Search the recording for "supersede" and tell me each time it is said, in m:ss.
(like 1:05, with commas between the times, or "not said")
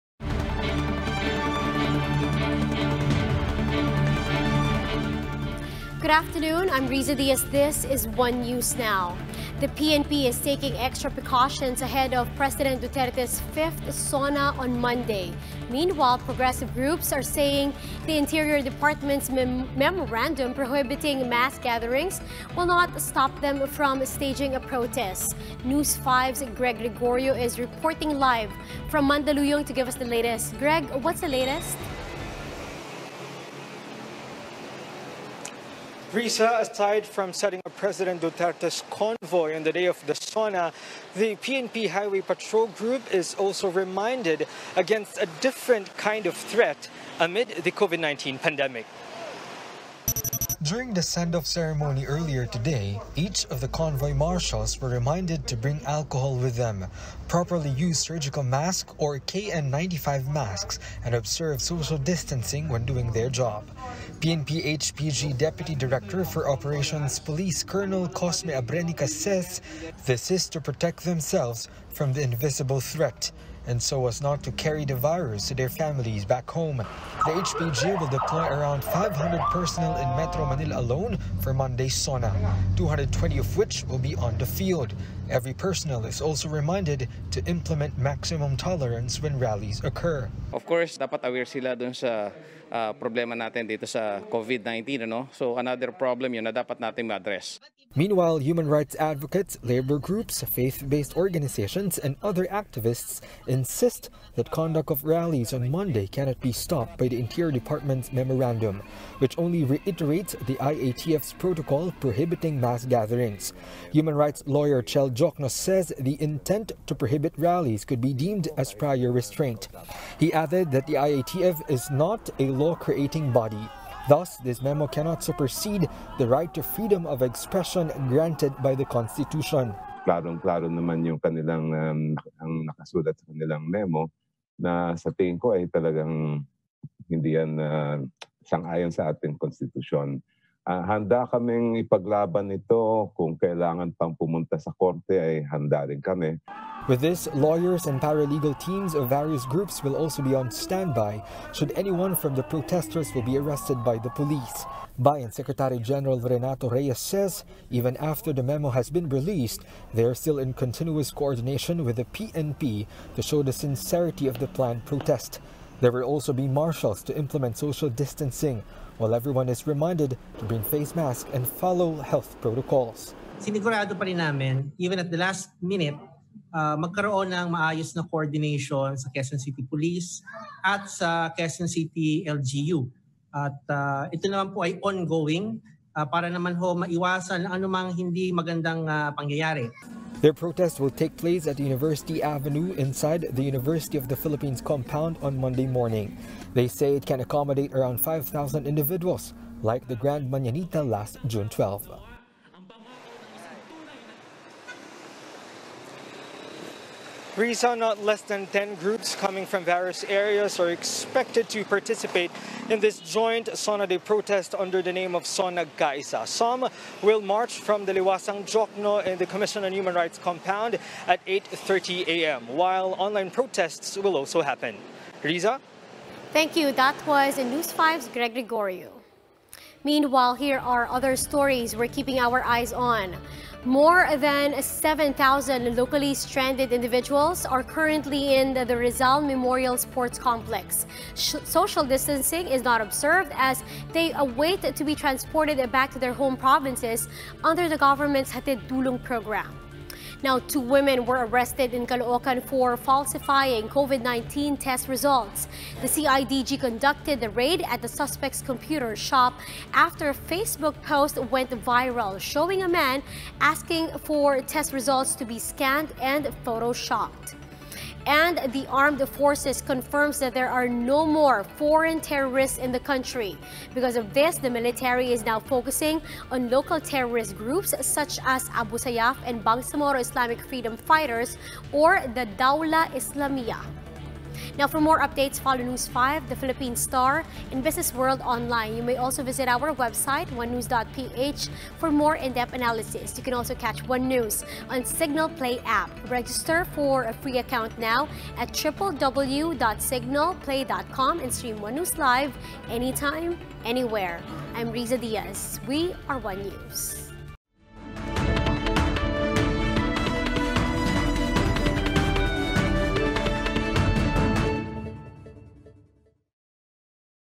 2:05.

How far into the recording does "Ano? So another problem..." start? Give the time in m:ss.
1:35.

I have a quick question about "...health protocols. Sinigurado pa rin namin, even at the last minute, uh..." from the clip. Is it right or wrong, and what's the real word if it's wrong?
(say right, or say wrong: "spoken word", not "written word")
right.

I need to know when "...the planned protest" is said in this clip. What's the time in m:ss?
2:44.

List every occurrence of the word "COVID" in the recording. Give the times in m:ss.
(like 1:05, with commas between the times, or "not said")
0:47, 1:34, 4:13.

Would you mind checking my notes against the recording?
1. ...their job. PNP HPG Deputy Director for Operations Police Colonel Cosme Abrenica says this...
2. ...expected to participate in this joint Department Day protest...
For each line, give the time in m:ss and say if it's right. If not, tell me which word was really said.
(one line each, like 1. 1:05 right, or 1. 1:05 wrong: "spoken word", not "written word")
1. 1:03 right
2. 3:30 wrong: "Sona", not "Department".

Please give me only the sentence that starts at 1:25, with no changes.
Every personnel is also reminded to implement maximum tolerance when rallies occur.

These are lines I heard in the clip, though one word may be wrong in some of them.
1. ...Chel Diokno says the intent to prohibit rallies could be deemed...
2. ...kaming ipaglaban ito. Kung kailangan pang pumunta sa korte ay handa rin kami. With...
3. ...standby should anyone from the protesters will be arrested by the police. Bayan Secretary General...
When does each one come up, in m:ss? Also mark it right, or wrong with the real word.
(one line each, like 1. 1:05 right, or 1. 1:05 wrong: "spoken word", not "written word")
1. 1:54 right
2. 2:21 right
3. 2:30 right.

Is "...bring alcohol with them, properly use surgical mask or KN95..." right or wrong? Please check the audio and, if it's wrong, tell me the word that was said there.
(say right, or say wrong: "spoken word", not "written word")
right.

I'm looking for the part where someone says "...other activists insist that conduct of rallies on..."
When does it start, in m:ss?
1:42.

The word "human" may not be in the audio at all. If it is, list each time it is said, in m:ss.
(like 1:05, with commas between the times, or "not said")
1:38, 1:53, 3:39.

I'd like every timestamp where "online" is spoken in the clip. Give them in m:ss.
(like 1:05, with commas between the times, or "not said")
3:42, 4:48.